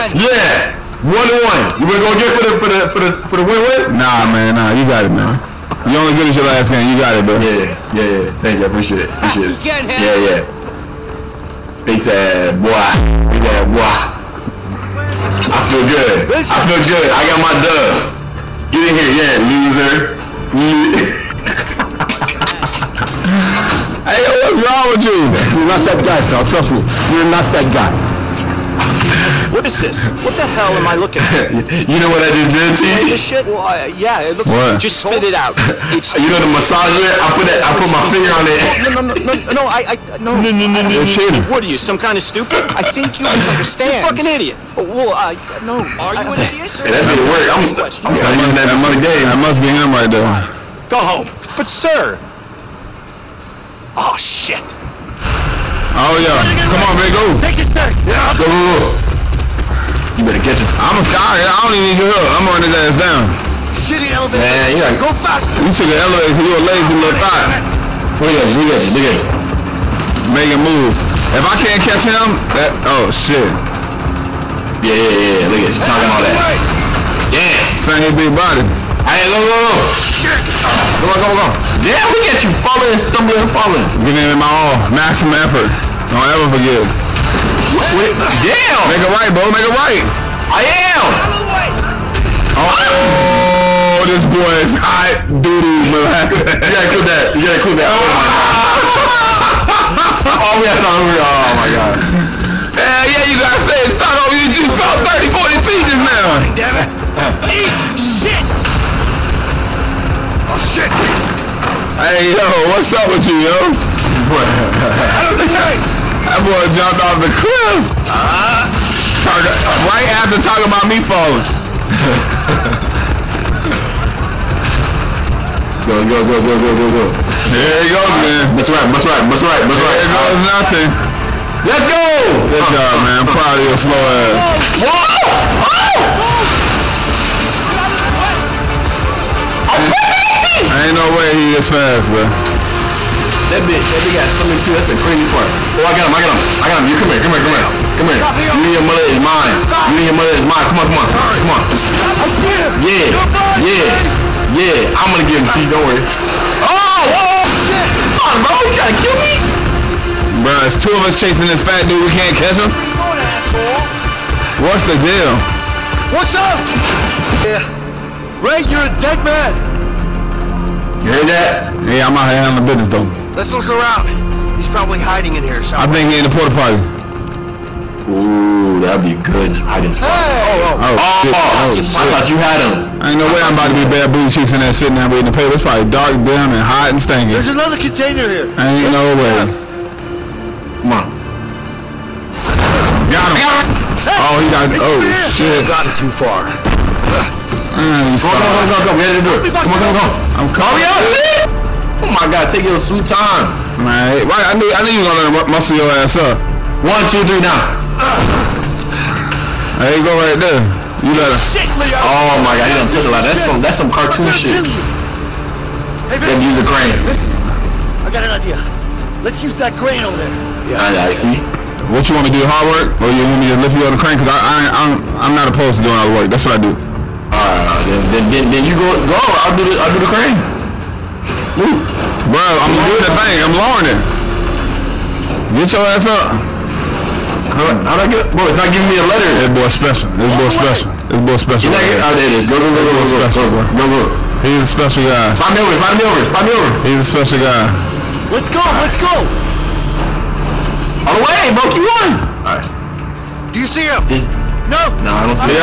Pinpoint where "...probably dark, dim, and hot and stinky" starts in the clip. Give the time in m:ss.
3:05.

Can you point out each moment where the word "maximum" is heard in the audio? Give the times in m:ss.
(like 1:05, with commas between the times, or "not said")
1:24.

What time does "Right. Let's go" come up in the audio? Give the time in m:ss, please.
4:08.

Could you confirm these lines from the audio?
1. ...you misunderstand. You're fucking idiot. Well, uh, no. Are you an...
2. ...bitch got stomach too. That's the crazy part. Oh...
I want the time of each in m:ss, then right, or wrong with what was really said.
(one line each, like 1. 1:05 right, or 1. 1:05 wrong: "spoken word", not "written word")
1. 0:43 right
2. 2:24 right.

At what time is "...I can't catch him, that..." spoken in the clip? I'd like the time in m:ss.
1:11.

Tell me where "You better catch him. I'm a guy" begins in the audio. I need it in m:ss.
1:00.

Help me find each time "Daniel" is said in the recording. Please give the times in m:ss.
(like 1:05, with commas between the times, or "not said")
not said.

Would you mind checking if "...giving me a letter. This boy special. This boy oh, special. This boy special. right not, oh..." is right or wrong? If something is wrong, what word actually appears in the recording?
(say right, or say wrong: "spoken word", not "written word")
right.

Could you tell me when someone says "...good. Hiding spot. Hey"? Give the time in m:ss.
2:59.